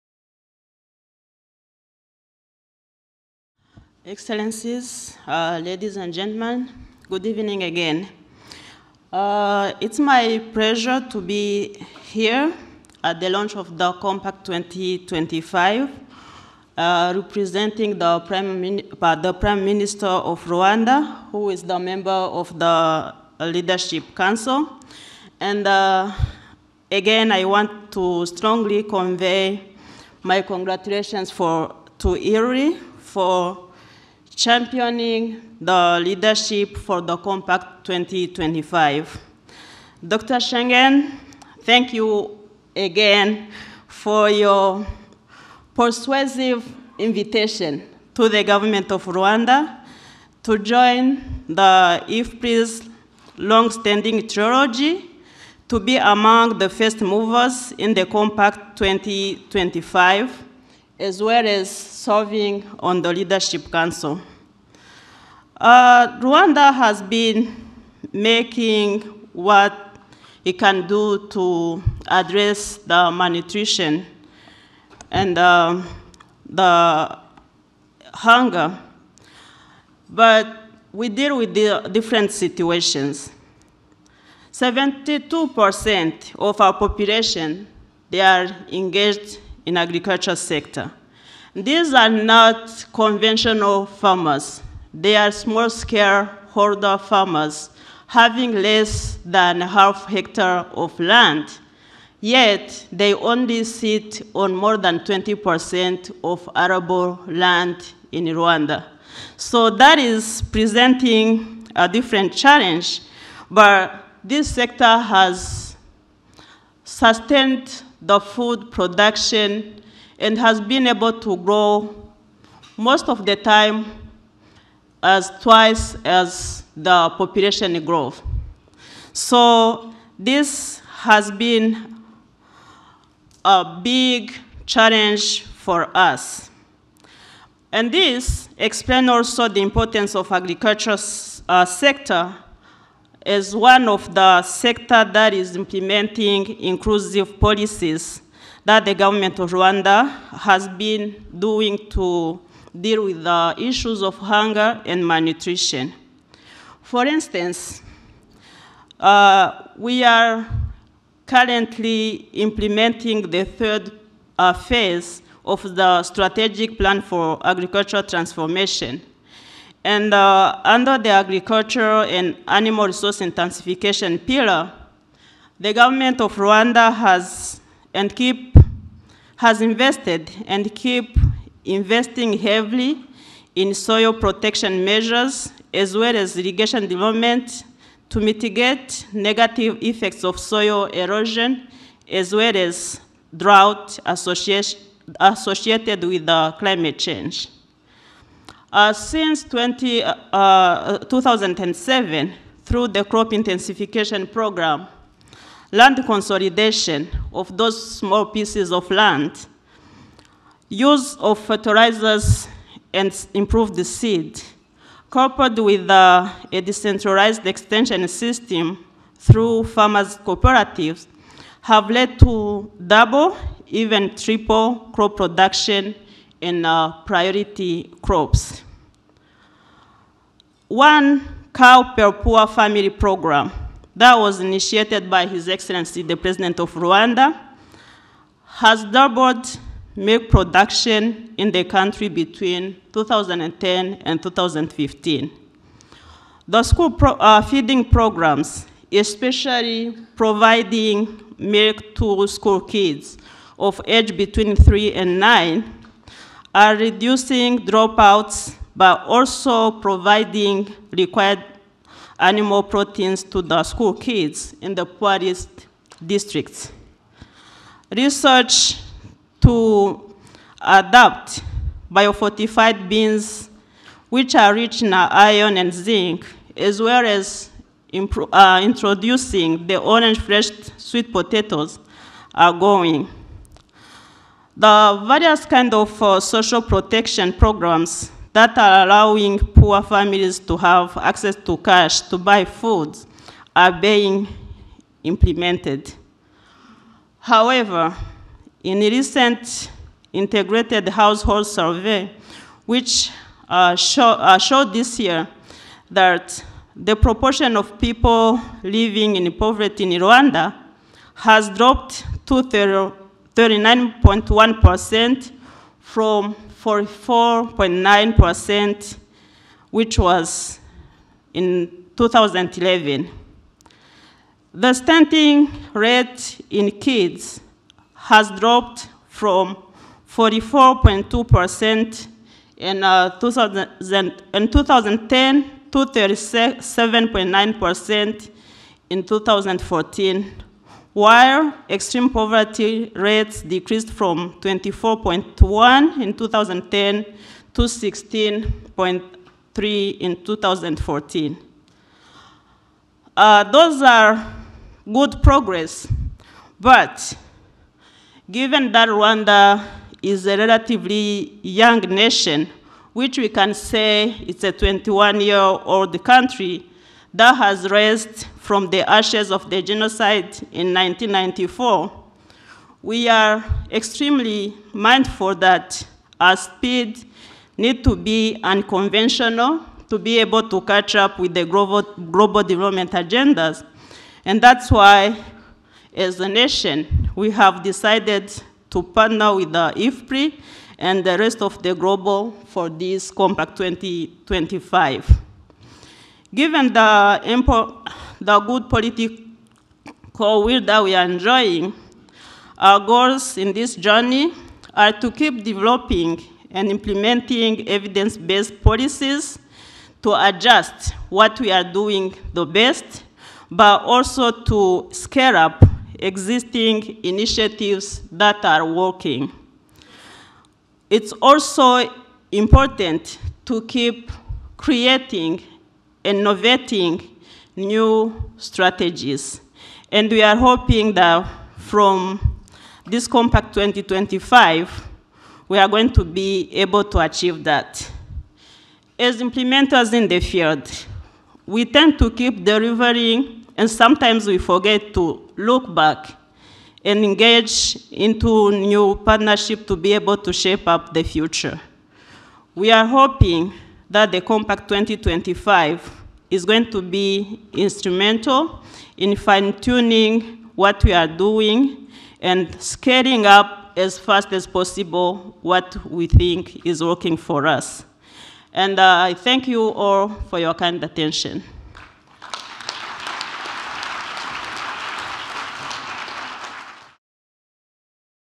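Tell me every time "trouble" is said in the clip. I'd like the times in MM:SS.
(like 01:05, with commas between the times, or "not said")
not said.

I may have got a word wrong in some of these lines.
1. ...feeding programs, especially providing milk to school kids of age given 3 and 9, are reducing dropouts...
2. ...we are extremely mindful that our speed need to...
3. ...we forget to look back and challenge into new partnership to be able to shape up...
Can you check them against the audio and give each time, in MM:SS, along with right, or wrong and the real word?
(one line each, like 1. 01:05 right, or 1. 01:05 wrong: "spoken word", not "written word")
1. 04:07 wrong: "between", not "given"
2. 06:12 right
3. 07:24 wrong: "engage", not "challenge".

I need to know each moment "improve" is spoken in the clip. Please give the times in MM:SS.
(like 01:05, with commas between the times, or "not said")
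03:33.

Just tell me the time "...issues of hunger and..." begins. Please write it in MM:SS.
02:33.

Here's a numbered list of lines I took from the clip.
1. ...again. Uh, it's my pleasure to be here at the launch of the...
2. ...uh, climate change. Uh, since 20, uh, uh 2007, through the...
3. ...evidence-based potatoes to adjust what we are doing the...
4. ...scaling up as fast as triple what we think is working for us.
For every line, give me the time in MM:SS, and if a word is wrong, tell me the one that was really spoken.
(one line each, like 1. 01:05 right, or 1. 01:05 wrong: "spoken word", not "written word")
1. 00:07 right
2. 03:16 right
3. 06:47 wrong: "policies", not "potatoes"
4. 07:42 wrong: "possible", not "triple".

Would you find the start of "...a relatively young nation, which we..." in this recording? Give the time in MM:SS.
06:00.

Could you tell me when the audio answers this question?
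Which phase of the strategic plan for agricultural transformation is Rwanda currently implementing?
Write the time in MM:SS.
02:43.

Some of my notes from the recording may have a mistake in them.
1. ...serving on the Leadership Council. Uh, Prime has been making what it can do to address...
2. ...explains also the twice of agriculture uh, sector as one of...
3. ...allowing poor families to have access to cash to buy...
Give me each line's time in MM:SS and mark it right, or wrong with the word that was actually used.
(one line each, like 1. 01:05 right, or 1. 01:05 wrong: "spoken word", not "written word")
1. 01:01 wrong: "Rwanda", not "Prime"
2. 02:18 wrong: "importance", not "twice"
3. 04:48 right.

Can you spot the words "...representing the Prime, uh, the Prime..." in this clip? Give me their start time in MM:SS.
00:17.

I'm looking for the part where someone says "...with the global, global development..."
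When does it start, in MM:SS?
06:21.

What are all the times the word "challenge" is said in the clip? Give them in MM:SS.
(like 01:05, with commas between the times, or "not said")
01:52, 02:14.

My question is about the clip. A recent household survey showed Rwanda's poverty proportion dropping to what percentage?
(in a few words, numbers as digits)
39.1%.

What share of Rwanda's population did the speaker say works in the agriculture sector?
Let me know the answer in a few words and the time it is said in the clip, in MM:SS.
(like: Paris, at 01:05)
72%, at 01:24.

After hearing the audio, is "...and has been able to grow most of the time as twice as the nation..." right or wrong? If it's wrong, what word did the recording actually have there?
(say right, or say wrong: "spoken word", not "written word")
wrong: "population", not "nation".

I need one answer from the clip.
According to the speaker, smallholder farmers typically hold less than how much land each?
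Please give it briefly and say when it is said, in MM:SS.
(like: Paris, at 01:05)
half hectare, at 01:39.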